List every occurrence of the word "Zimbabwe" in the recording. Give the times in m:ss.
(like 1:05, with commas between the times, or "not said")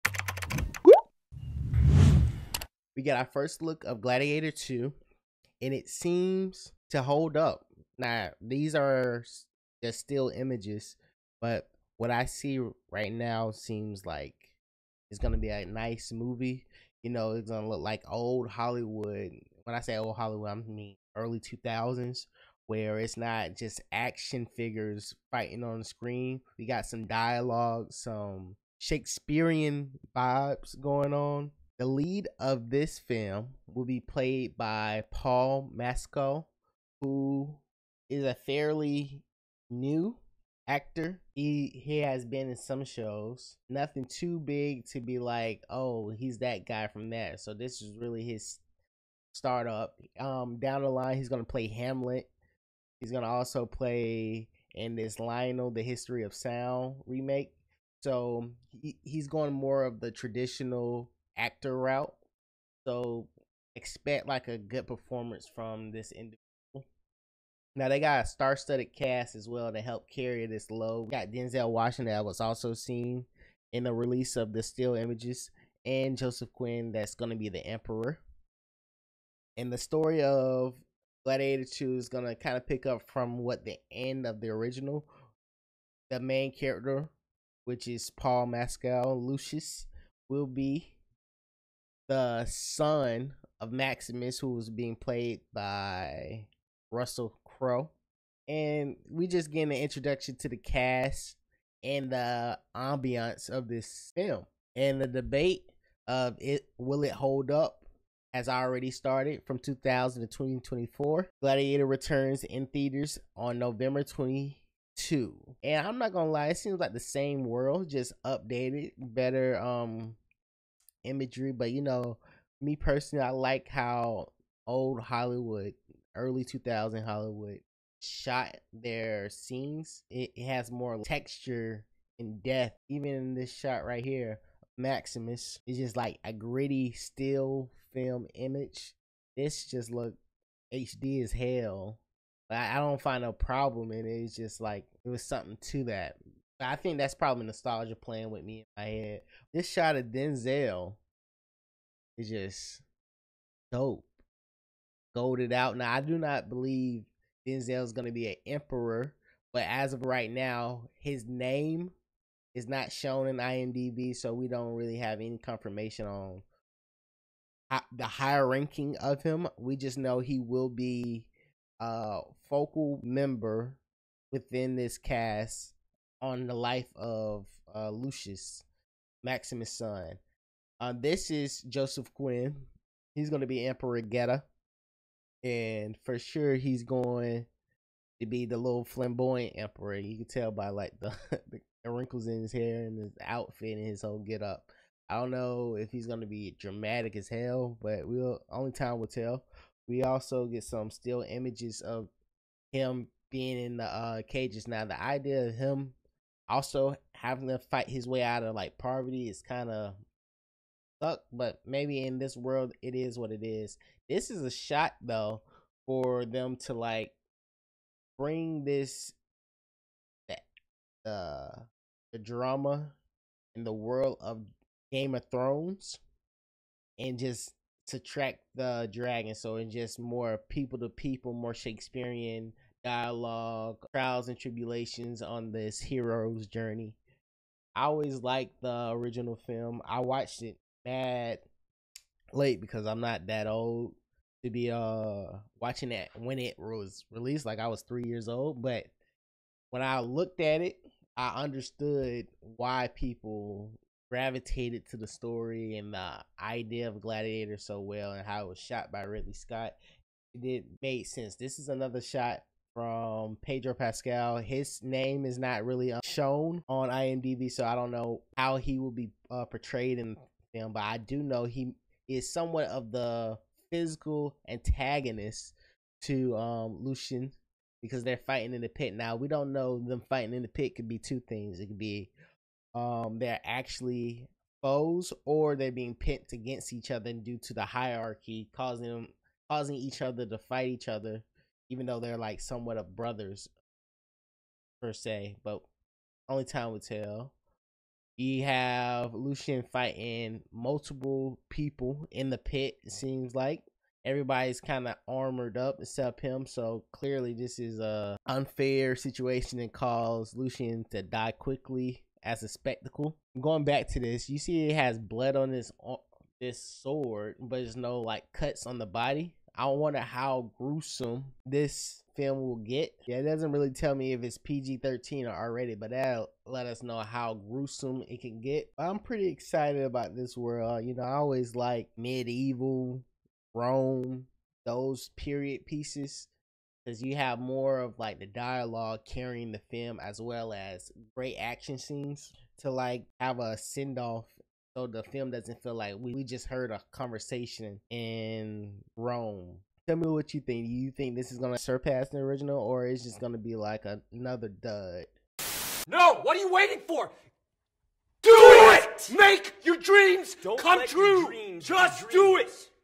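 not said.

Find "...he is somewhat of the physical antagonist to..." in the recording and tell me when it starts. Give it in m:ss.
4:31.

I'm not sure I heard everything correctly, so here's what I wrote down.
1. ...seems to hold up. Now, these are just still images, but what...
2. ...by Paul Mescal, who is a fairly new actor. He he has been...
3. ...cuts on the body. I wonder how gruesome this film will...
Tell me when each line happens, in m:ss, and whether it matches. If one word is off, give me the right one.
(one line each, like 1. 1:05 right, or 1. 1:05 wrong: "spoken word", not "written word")
1. 0:05 right
2. 0:34 right
3. 5:18 right.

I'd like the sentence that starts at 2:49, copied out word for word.
We just know he will be a focal member within this cast on the life of uh, Lucius, Maximus' son.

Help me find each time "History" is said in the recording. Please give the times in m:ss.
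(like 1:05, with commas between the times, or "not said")
0:55.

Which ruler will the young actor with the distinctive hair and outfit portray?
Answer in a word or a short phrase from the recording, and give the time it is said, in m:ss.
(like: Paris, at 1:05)
Emperor Geta, at 3:03.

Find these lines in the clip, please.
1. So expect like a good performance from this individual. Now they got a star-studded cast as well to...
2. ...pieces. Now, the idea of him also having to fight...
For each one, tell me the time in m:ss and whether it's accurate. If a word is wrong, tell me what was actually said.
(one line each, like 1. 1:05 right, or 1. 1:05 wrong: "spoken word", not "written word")
1. 1:02 right
2. 3:24 wrong: "cages", not "pieces".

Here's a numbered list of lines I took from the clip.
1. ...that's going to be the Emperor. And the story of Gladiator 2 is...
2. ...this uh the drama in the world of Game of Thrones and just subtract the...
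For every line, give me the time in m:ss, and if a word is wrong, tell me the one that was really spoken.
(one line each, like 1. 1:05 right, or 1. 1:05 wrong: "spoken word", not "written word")
1. 1:16 right
2. 3:38 right.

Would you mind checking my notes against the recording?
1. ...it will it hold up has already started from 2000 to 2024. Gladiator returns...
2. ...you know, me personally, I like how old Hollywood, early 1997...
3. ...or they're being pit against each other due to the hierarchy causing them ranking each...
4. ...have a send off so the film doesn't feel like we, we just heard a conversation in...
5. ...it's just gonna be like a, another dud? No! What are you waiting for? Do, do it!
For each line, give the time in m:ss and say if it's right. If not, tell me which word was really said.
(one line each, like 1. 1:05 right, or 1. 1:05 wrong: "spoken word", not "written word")
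1. 1:46 right
2. 2:01 wrong: "2000", not "1997"
3. 4:45 wrong: "causing", not "ranking"
4. 5:43 right
5. 5:52 right.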